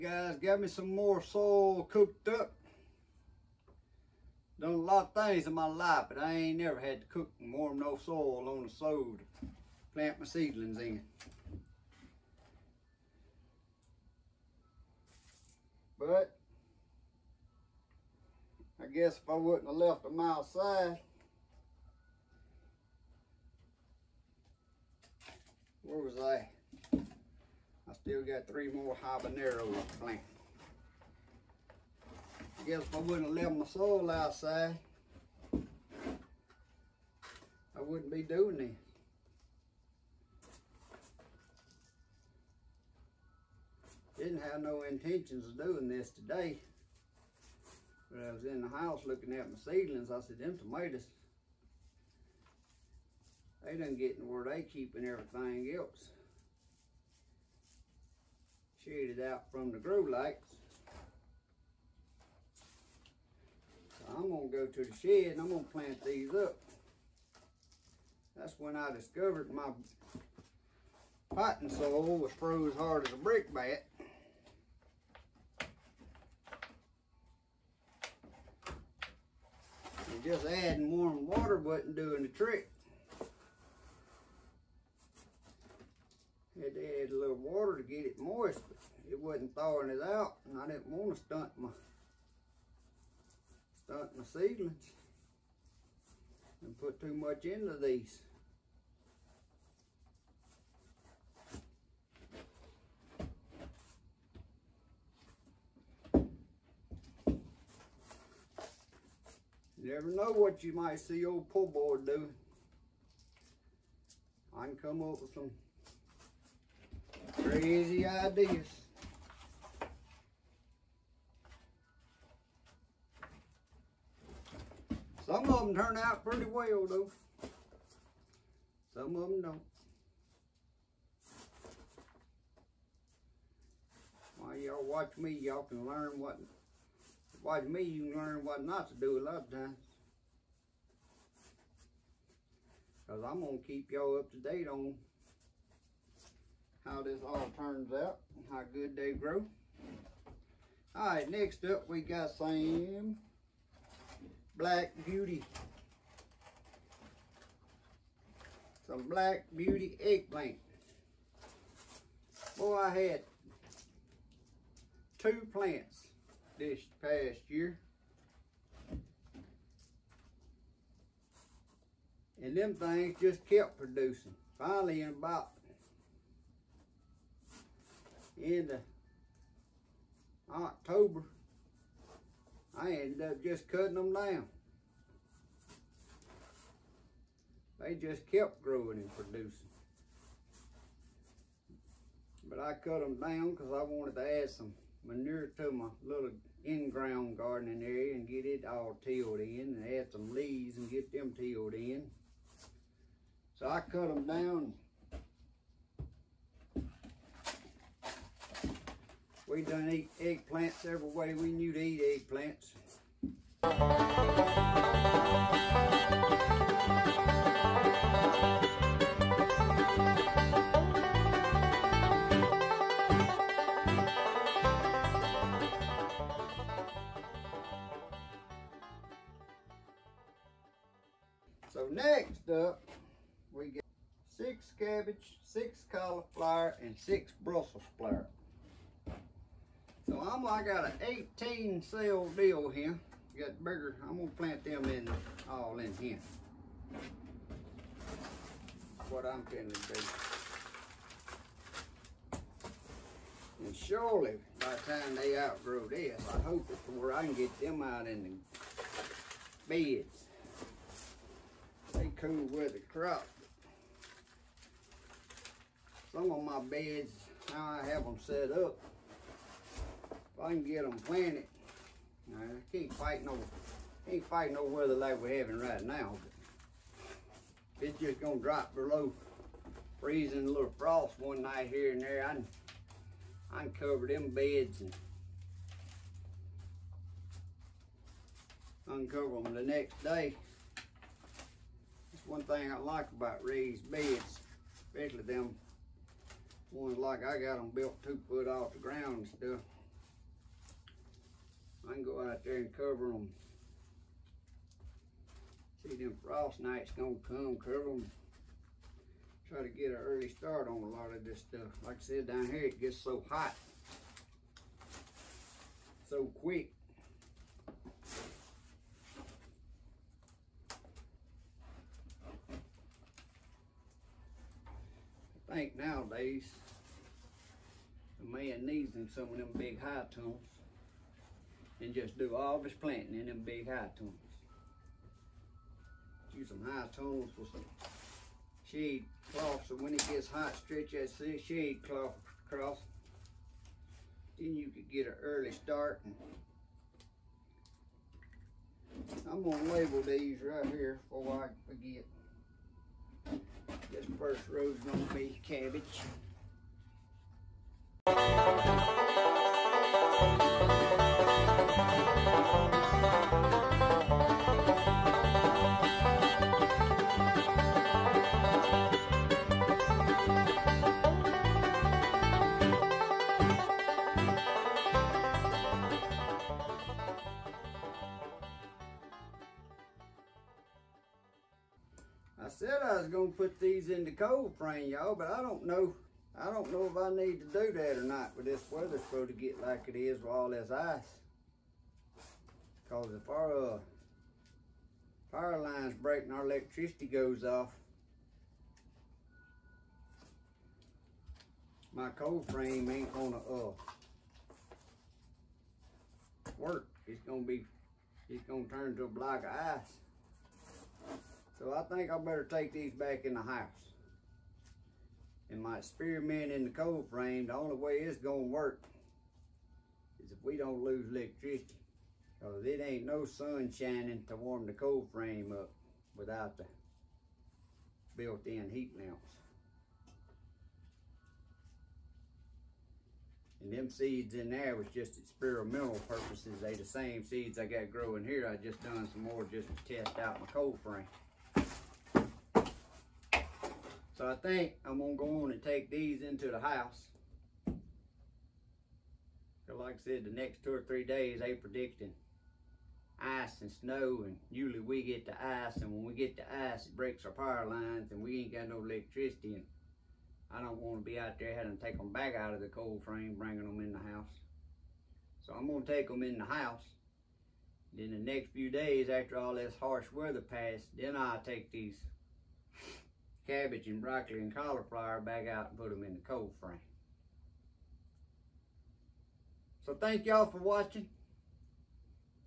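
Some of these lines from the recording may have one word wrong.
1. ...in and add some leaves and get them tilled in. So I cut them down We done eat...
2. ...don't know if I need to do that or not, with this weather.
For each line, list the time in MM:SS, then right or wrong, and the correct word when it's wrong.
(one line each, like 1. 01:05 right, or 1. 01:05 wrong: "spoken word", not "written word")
1. 03:19 right
2. 06:26 right.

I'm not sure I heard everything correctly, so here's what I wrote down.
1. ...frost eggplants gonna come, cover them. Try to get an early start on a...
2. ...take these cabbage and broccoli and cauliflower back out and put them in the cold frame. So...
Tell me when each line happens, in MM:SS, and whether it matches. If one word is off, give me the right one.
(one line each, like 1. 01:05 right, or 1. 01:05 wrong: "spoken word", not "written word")
1. 05:06 wrong: "nights", not "eggplants"
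2. 07:51 right.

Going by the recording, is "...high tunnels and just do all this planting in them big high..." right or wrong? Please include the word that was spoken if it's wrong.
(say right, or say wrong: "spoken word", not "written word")
right.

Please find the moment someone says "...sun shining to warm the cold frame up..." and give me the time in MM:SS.
07:03.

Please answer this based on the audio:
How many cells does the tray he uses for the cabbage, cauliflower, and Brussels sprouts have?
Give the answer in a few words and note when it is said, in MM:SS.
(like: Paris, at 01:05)
18, at 04:01.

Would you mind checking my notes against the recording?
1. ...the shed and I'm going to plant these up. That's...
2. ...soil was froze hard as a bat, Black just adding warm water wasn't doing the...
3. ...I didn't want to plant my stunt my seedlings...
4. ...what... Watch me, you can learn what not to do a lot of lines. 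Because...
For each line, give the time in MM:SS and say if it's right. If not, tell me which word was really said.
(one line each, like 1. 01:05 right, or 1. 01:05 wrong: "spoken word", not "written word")
1. 01:04 right
2. 01:11 wrong: "And", not "Black"
3. 01:30 wrong: "stunt", not "plant"
4. 02:16 wrong: "times", not "lines".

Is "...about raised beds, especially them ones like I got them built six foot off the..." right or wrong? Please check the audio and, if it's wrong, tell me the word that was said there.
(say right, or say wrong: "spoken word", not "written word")
wrong: "two", not "six".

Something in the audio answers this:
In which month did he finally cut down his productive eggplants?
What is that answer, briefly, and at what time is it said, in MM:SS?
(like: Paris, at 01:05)
October, at 03:00.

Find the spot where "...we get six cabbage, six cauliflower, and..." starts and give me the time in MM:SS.
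03:53.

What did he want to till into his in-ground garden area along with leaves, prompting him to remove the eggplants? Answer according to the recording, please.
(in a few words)
Manure.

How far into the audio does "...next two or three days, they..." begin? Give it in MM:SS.
07:30.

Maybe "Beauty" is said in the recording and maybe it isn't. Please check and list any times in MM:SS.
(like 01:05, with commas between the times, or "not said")
02:35, 02:39.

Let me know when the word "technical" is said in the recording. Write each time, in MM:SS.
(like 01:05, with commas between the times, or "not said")
not said.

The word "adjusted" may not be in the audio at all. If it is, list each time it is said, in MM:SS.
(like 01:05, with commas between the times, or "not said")
not said.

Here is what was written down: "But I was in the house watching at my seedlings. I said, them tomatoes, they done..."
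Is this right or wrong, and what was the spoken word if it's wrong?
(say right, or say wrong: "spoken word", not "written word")
wrong: "looking", not "watching".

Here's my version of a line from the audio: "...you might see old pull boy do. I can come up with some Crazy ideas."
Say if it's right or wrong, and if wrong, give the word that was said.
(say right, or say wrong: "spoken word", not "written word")
right.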